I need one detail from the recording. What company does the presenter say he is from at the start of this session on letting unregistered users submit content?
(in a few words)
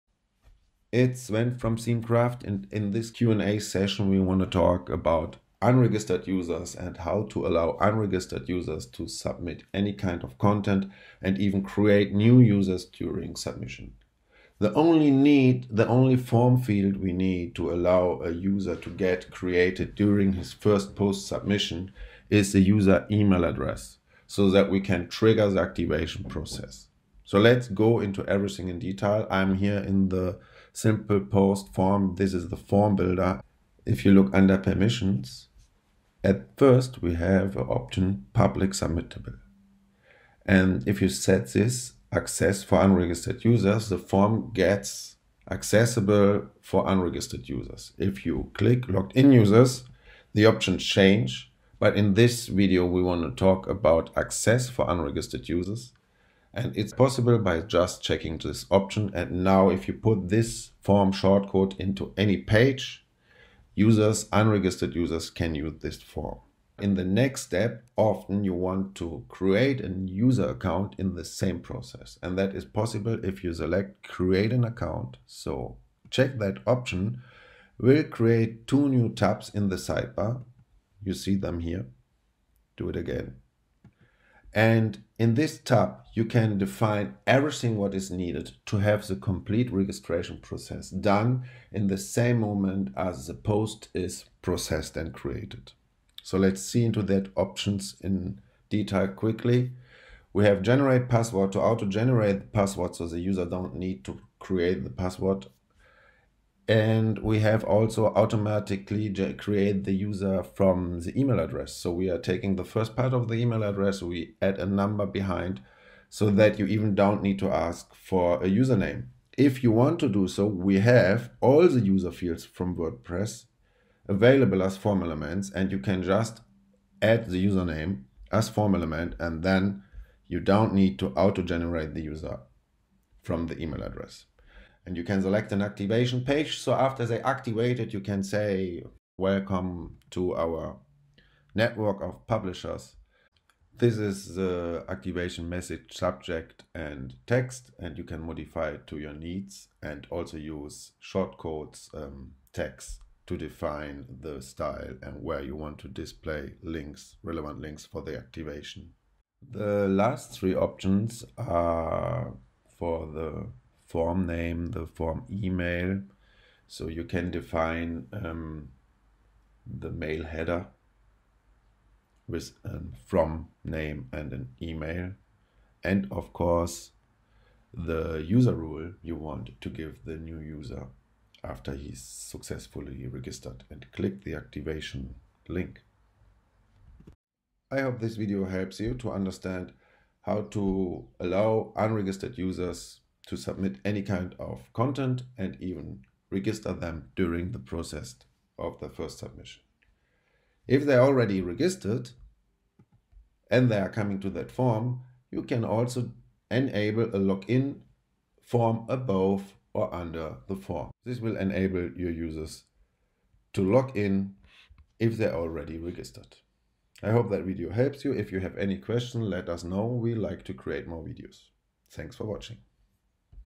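Themekraft.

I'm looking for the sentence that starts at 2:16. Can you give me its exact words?
So after they activate it, you can say, welcome to our network of publishers.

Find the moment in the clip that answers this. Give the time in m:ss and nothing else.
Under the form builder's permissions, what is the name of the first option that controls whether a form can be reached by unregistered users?
0:38.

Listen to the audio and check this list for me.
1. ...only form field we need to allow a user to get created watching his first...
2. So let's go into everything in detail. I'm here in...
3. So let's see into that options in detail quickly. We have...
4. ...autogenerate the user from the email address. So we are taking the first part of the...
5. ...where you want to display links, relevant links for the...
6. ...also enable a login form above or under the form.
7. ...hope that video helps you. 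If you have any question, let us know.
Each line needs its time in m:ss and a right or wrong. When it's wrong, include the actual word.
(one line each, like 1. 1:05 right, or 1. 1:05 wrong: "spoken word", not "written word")
1. 0:15 wrong: "during", not "watching"
2. 0:27 right
3. 1:36 right
4. 1:49 wrong: "create", not "autogenerate"
5. 2:35 right
6. 3:25 right
7. 3:37 right.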